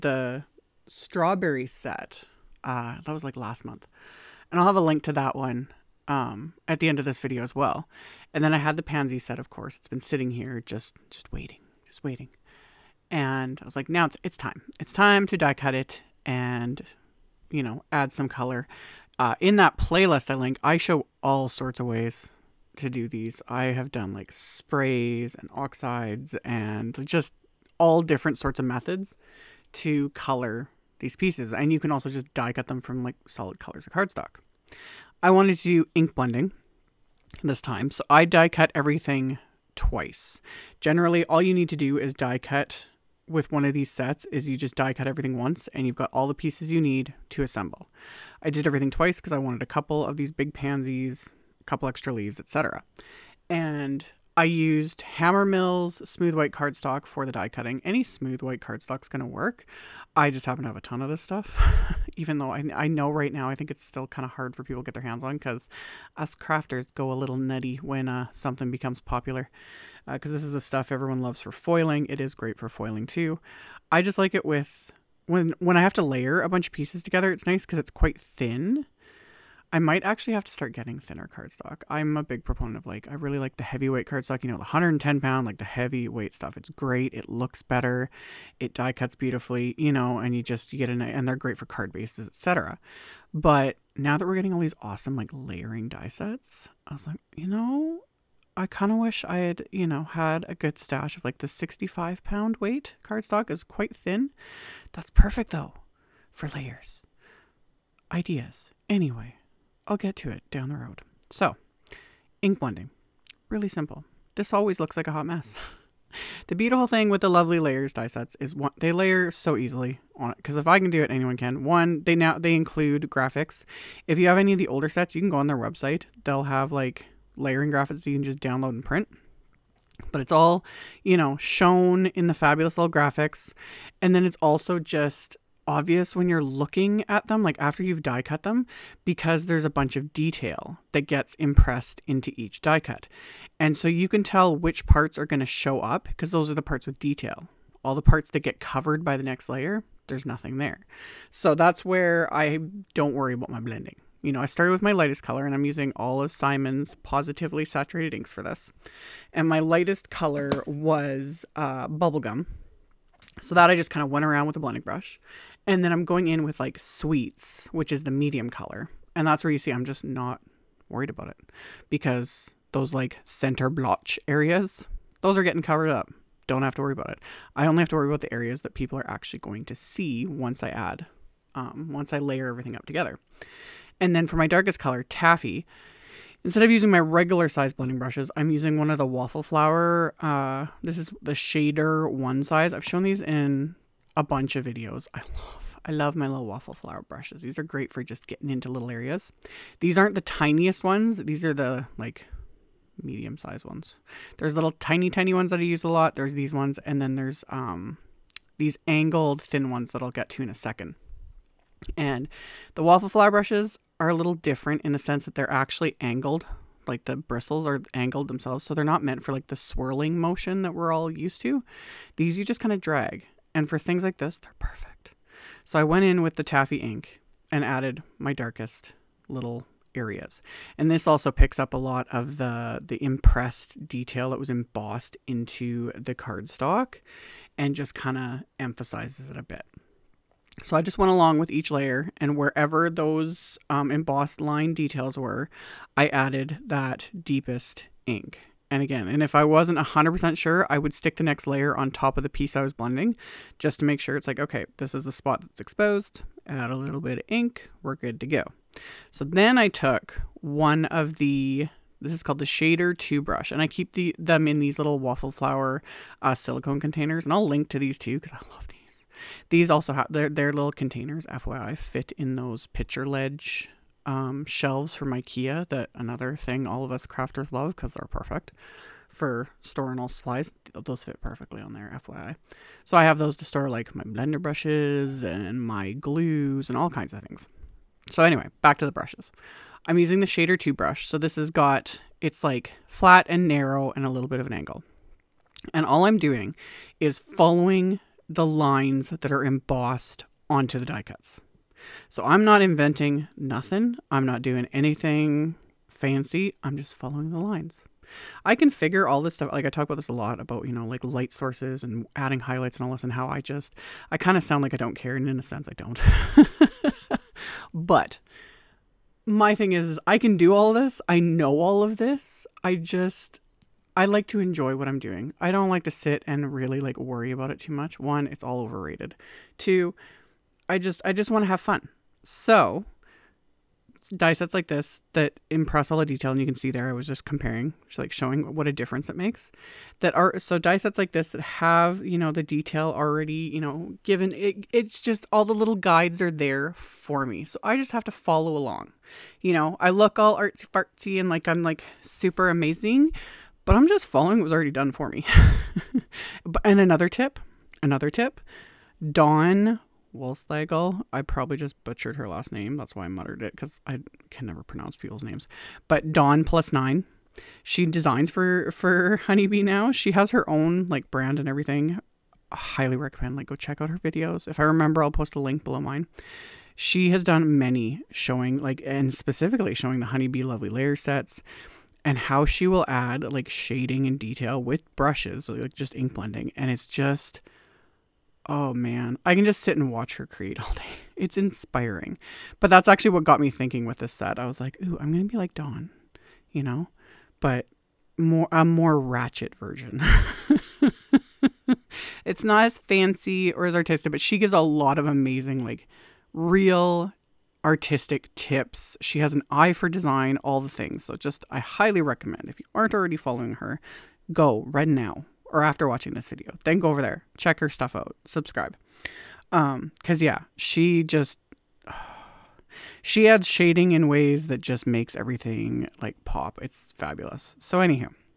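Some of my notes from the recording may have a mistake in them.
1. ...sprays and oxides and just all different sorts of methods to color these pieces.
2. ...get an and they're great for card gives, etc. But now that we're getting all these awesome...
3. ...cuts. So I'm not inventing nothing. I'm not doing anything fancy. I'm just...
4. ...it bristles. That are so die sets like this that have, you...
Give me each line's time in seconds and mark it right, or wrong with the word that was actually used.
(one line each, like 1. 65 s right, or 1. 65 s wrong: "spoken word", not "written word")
1. 24 s right
2. 90 s wrong: "bases", not "gives"
3. 301 s right
4. 339 s wrong: "makes", not "bristles".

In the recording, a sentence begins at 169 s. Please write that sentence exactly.
And that's where you see I'm just not worried about it because those like center blotch areas, those are getting covered up.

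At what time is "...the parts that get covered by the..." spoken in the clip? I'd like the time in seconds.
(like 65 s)
147 s.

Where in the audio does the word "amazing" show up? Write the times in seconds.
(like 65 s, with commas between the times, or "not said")
352 s, 405 s.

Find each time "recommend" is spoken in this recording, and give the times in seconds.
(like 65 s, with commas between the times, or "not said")
372 s, 412 s.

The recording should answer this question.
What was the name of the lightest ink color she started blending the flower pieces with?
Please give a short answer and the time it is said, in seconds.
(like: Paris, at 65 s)
Bubblegum, at 161 s.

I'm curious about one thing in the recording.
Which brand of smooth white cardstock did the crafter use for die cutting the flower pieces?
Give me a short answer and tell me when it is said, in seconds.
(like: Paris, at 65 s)
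Hammermill, at 55 s.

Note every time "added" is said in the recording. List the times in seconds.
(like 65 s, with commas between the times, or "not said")
227 s, 246 s.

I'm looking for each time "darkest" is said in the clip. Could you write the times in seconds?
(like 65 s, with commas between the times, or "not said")
184 s, 228 s.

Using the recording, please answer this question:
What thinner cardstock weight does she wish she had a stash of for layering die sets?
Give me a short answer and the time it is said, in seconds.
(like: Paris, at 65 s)
65 pound, at 101 s.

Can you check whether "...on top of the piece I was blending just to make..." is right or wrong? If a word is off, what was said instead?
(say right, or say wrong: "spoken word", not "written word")
right.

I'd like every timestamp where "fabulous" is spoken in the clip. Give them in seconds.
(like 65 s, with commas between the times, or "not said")
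132 s, 426 s.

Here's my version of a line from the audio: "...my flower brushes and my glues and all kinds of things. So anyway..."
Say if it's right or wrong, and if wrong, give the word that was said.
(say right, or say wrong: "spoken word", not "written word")
wrong: "blender", not "flower".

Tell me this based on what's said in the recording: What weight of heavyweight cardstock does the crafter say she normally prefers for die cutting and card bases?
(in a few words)
110 pound.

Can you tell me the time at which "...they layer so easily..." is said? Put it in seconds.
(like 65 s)
118 s.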